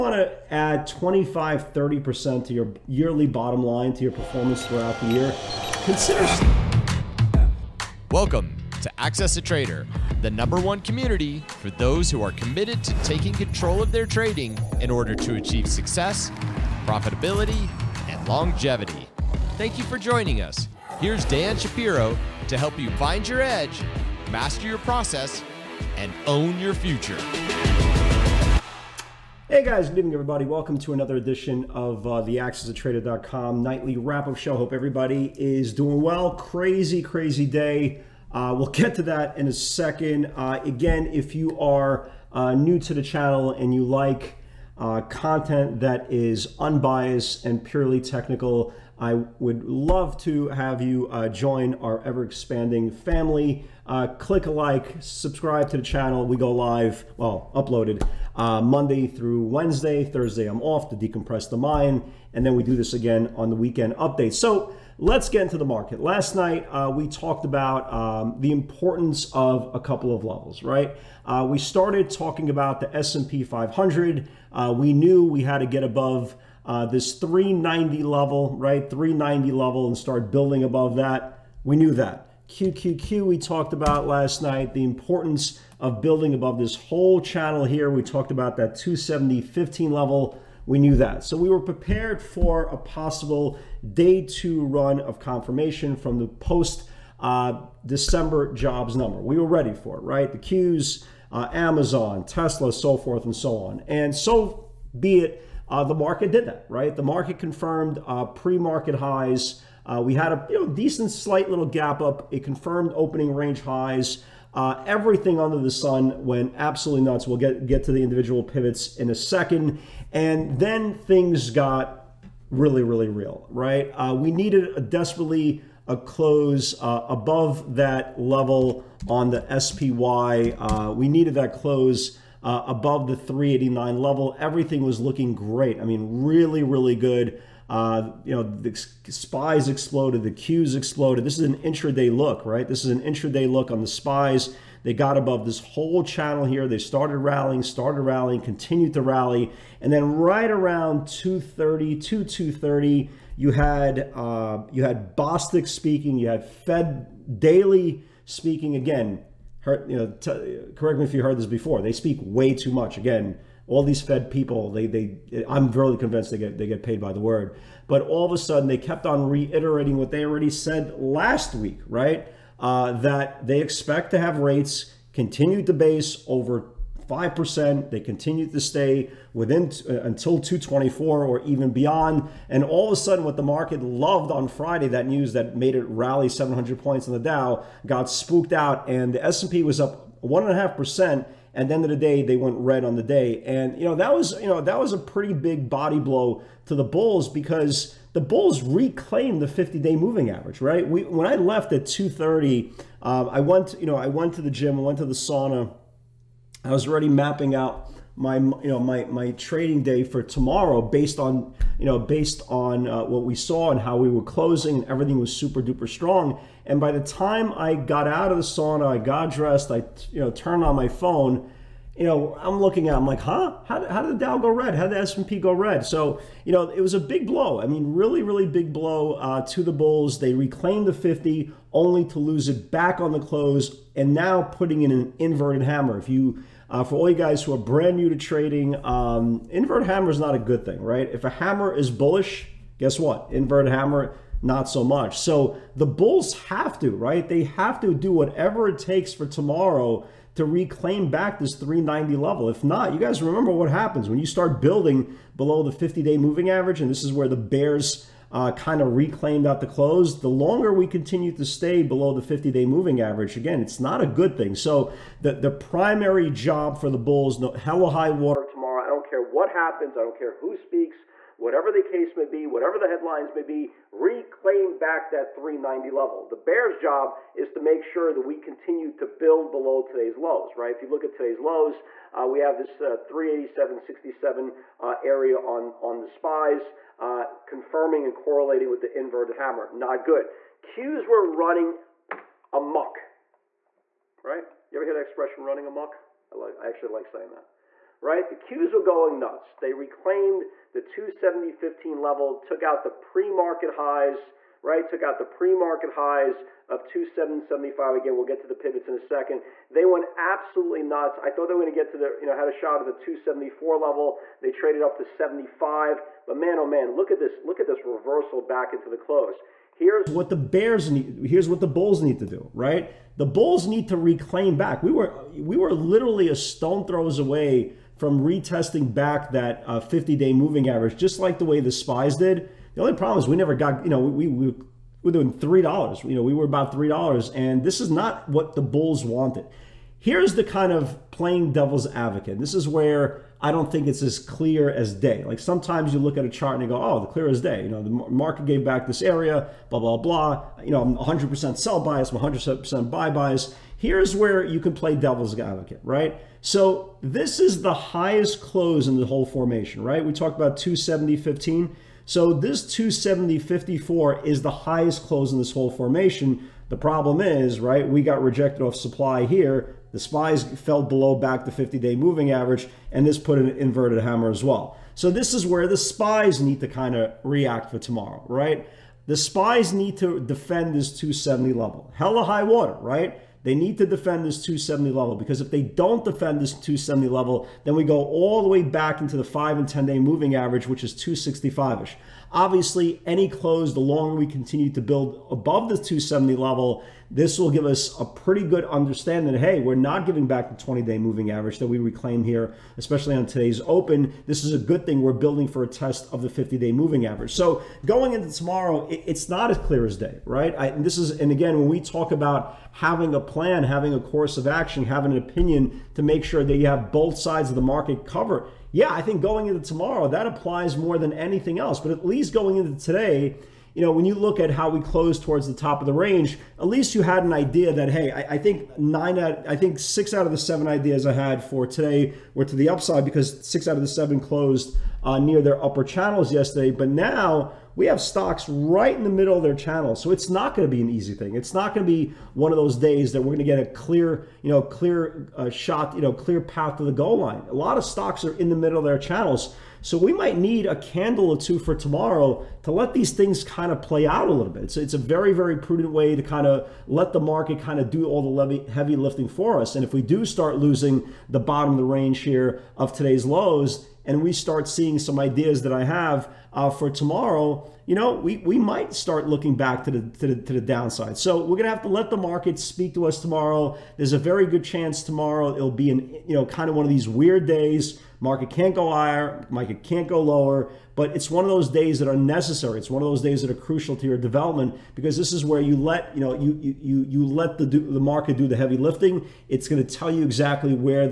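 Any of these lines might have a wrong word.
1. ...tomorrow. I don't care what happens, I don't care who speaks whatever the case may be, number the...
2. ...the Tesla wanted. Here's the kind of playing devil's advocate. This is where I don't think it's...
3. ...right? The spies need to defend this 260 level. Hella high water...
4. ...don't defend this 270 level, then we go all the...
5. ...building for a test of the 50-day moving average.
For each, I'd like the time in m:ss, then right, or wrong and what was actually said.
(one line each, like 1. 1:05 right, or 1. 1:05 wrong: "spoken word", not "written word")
1. 4:28 wrong: "whatever", not "number"
2. 5:38 wrong: "Bulls", not "Tesla"
3. 6:18 wrong: "270", not "260"
4. 6:25 right
5. 6:45 right.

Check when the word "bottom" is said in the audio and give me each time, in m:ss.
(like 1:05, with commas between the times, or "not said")
0:03, 7:41.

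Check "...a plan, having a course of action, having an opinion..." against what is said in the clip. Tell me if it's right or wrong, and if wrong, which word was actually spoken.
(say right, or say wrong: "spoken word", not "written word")
right.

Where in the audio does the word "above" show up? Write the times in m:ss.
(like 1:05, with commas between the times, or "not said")
1:15, 1:20, 1:26, 2:07, 2:12, 2:25, 6:35.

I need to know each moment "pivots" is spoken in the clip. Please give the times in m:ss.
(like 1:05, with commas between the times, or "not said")
1:58, 5:08.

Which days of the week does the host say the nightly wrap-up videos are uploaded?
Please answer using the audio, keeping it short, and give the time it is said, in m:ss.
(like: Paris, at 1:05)
Monday through Wednesday, at 0:58.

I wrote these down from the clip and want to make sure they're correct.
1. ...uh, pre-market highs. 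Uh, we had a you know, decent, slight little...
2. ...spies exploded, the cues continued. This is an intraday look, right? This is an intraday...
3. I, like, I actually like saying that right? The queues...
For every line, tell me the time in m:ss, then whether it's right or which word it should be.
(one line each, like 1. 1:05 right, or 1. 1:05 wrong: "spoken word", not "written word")
1. 1:48 right
2. 2:19 wrong: "exploded", not "continued"
3. 4:56 right.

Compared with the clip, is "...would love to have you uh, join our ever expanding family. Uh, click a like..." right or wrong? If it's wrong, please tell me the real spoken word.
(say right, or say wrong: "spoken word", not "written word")
right.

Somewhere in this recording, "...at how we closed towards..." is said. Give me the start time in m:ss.
7:04.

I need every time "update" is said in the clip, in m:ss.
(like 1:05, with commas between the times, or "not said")
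1:03.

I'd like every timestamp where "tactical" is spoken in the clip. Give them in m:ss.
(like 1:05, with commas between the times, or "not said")
not said.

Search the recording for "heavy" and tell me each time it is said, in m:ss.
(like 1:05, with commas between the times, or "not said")
7:38, 8:08.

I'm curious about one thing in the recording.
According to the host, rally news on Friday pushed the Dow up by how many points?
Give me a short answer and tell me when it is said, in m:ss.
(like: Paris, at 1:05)
700, at 3:06.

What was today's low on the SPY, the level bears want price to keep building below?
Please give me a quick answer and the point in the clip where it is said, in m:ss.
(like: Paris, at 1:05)
387.67, at 4:43.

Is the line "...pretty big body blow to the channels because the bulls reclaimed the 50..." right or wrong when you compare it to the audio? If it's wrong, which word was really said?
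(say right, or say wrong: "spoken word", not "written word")
wrong: "bulls", not "channels".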